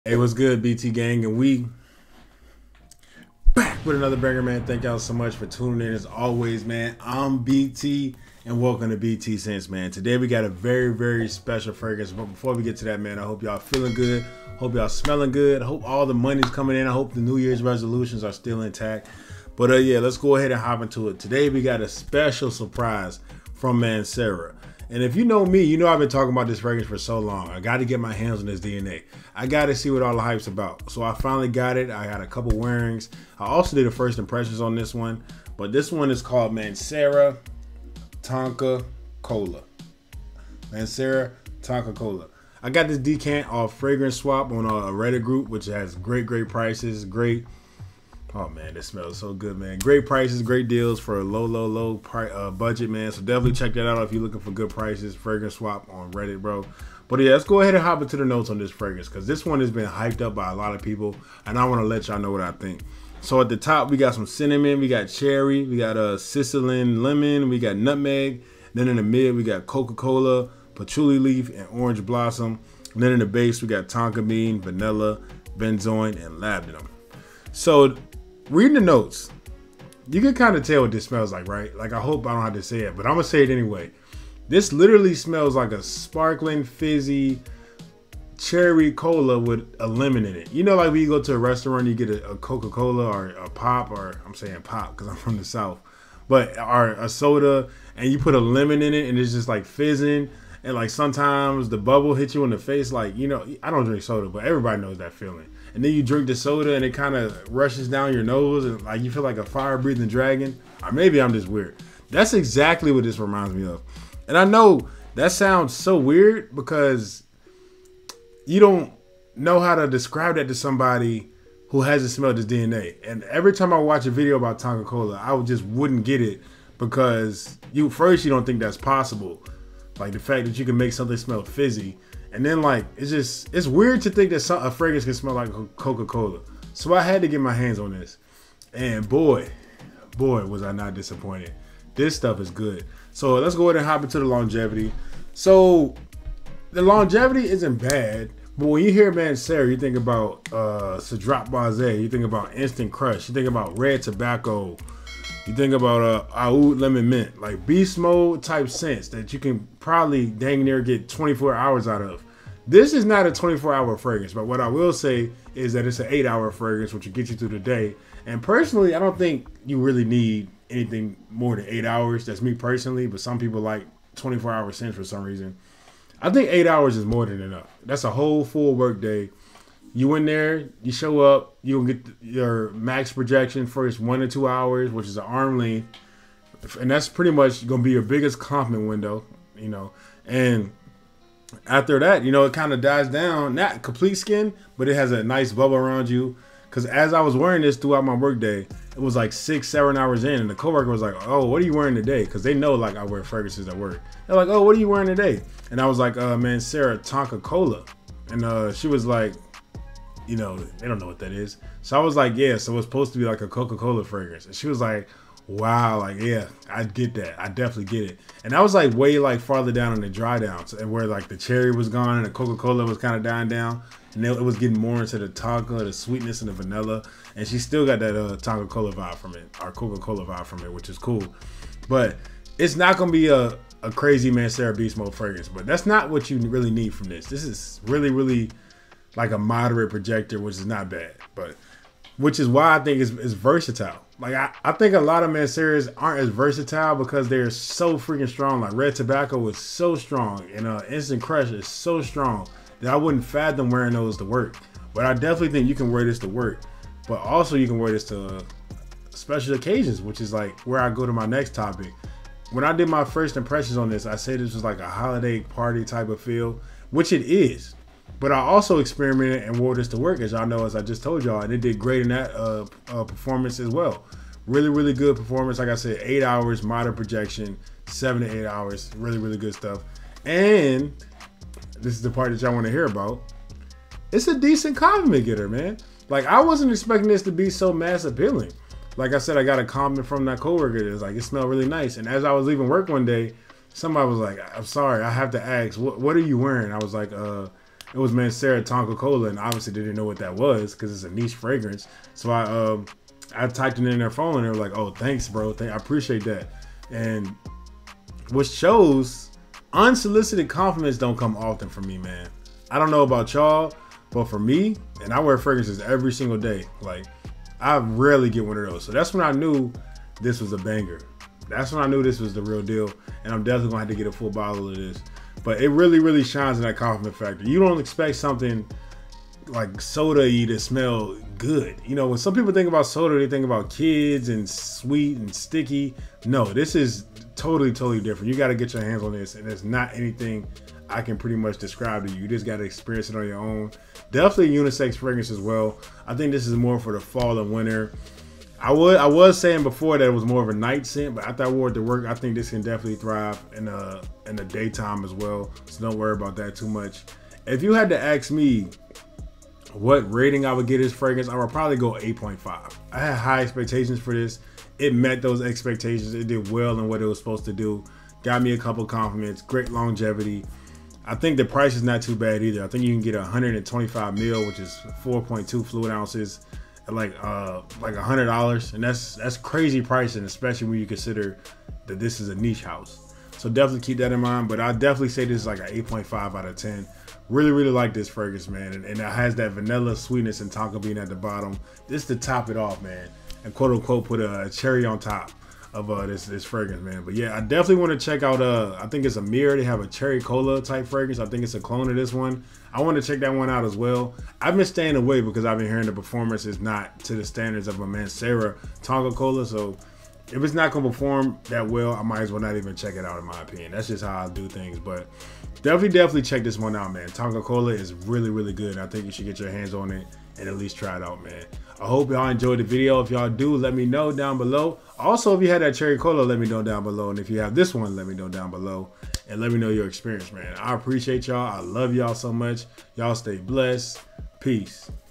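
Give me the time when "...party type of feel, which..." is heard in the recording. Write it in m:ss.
4:25.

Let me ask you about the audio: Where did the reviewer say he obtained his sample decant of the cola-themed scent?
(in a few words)
Fragrance Swap on Reddit.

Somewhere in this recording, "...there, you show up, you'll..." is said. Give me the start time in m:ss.
3:00.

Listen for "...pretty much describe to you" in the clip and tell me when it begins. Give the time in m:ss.
5:41.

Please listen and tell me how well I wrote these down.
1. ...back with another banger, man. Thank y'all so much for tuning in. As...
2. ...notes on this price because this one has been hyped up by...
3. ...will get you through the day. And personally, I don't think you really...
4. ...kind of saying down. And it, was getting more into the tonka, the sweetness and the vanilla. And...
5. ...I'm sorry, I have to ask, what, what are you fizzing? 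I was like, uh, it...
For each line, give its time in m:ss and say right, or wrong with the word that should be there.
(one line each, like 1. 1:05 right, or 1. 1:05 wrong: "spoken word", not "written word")
1. 0:03 right
2. 0:58 wrong: "fragrance", not "price"
3. 2:47 right
4. 3:42 wrong: "dying", not "saying"
5. 4:54 wrong: "wearing", not "fizzing".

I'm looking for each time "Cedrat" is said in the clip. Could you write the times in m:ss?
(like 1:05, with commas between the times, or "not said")
2:30.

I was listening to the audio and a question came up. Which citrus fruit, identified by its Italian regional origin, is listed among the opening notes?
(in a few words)
Sicilian lemon.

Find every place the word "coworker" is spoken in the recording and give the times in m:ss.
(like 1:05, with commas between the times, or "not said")
3:20, 4:50.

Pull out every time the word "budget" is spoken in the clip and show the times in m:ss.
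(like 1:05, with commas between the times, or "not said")
0:52.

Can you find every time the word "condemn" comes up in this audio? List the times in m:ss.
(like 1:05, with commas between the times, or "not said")
not said.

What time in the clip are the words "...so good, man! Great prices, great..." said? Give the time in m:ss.
0:49.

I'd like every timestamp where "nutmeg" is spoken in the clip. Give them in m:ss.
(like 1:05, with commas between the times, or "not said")
1:07.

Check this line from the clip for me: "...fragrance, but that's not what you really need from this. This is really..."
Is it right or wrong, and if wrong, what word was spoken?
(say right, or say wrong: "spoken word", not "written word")
right.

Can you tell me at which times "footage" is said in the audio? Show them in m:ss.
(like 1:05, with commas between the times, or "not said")
not said.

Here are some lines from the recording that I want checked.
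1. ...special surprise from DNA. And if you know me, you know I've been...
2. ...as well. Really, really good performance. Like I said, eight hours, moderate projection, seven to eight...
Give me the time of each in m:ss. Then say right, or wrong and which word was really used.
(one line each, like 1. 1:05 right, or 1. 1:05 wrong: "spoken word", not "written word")
1. 0:21 wrong: "Mancera", not "DNA"
2. 4:33 right.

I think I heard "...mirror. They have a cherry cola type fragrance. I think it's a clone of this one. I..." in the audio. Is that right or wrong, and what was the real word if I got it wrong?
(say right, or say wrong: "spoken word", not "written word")
right.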